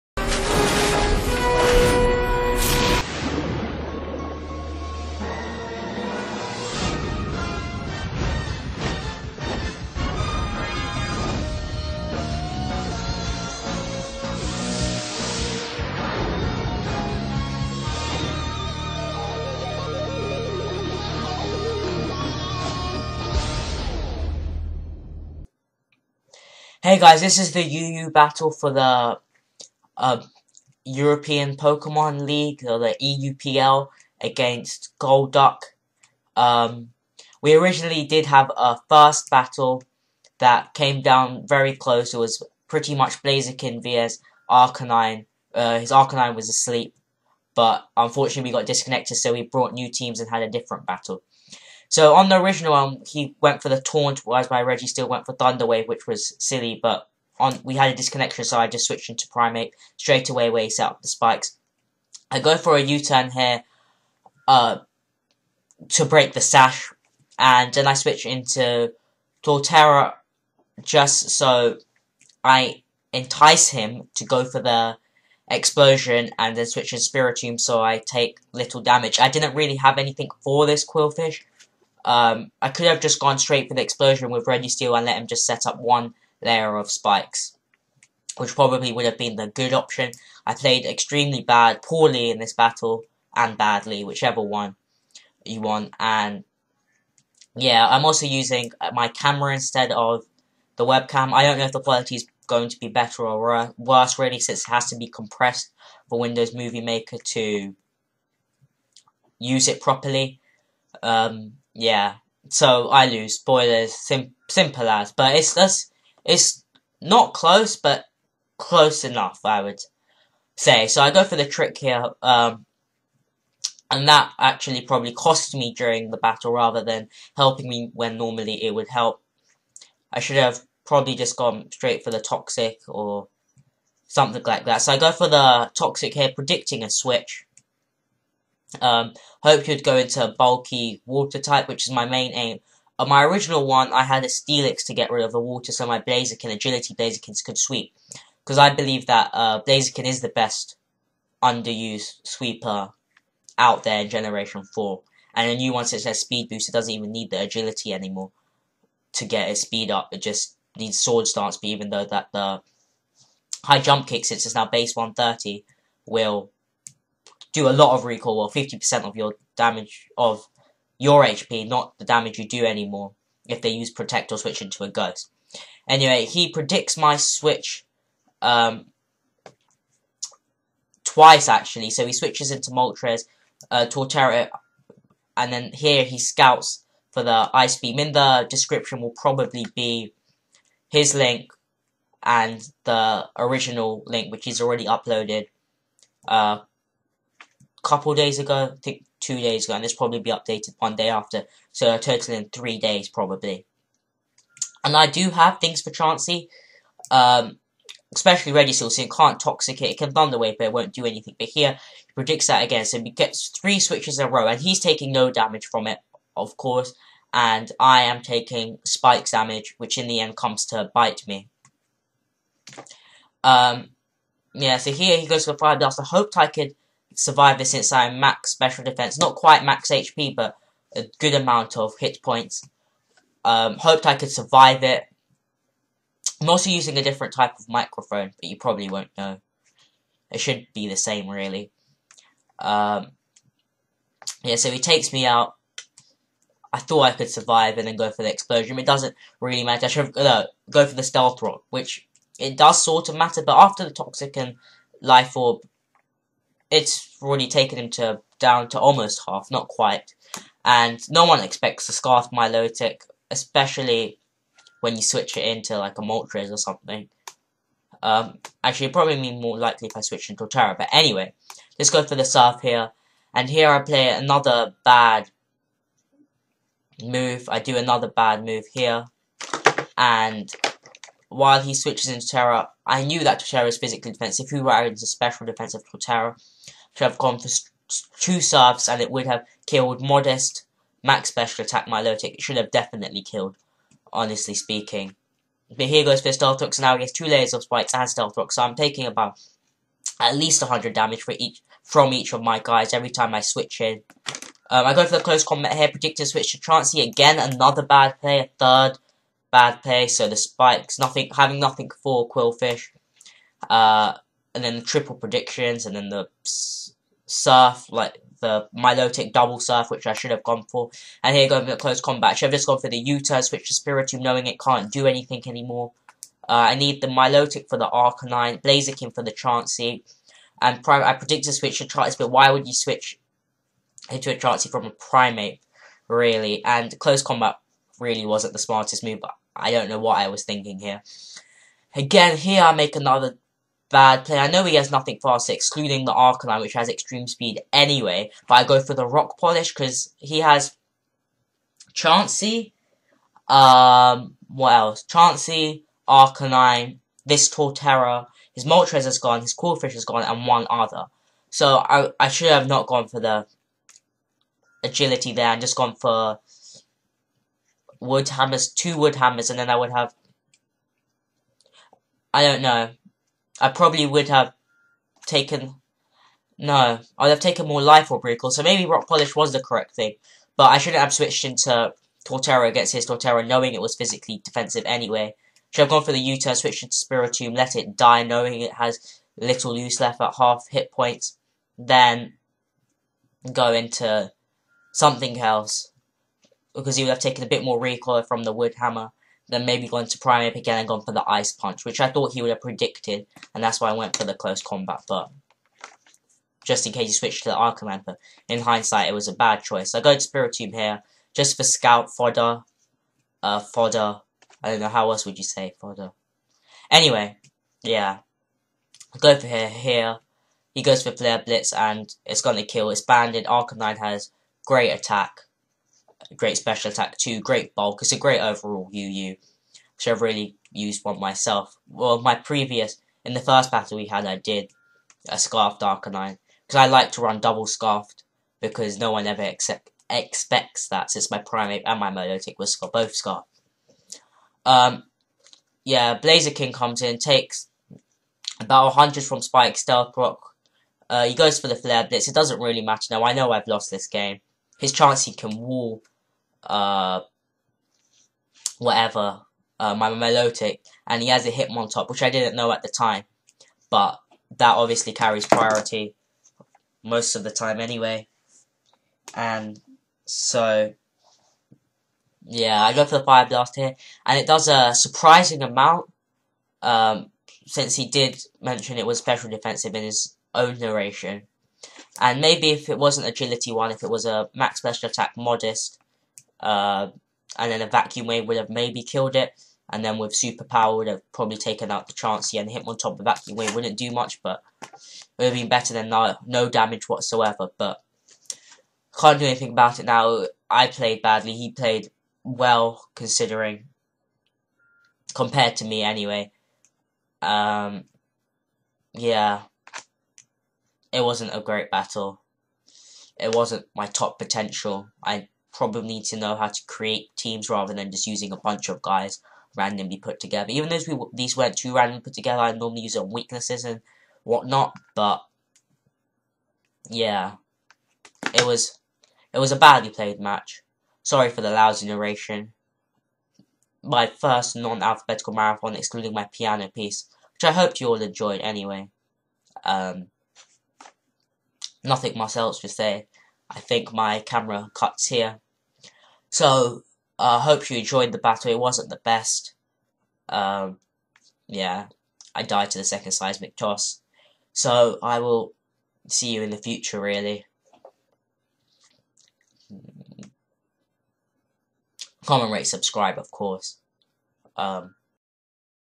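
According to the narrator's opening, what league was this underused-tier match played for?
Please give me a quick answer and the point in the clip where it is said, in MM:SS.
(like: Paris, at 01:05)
European Pokemon League, at 00:30.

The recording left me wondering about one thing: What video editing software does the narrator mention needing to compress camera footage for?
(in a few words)
Windows Movie Maker.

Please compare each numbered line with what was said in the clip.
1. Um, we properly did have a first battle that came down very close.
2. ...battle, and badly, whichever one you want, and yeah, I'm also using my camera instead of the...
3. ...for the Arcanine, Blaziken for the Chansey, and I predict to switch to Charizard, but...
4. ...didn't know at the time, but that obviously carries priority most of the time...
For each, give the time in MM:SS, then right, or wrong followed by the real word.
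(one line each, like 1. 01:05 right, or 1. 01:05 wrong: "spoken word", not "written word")
1. 00:36 wrong: "originally", not "properly"
2. 01:32 right
3. 05:27 right
4. 07:42 right.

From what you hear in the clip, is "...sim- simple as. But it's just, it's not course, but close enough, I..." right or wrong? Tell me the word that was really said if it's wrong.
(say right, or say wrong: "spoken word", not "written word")
wrong: "close", not "course".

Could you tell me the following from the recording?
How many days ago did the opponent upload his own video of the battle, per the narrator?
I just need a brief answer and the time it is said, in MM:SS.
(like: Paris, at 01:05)
2, at 03:19.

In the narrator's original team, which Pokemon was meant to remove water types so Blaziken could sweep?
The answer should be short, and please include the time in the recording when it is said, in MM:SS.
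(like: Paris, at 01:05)
Steelix, at 02:24.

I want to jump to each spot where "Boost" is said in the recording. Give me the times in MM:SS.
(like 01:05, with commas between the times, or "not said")
02:36.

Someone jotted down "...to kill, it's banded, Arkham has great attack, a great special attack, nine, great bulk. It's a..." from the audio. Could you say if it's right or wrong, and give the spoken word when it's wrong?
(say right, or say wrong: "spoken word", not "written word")
wrong: "two", not "nine".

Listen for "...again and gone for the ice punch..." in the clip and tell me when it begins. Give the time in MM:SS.
06:40.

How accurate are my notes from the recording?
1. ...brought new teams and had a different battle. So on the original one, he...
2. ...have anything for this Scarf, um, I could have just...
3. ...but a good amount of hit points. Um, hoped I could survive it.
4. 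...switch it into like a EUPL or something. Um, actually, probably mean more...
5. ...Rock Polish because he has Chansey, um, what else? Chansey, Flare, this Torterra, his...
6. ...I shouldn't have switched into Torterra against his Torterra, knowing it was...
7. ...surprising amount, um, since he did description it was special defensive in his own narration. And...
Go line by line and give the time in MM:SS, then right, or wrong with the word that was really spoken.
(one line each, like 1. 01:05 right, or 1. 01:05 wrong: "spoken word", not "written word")
1. 00:49 right
2. 01:19 wrong: "Qwilfish", not "Scarf"
3. 03:50 right
4. 04:25 wrong: "Moltres", not "EUPL"
5. 05:49 wrong: "Arcanine", not "Flare"
6. 06:20 right
7. 07:54 wrong: "mention", not "description".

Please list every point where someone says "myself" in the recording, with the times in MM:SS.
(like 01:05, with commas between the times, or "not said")
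07:11, 09:02.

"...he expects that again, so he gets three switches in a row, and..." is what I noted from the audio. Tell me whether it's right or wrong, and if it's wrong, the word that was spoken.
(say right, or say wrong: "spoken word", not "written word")
wrong: "predicts", not "expects".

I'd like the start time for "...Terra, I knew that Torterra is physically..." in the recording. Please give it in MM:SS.
04:42.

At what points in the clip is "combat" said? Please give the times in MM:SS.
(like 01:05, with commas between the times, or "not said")
05:05, 05:22, 05:37, 06:44.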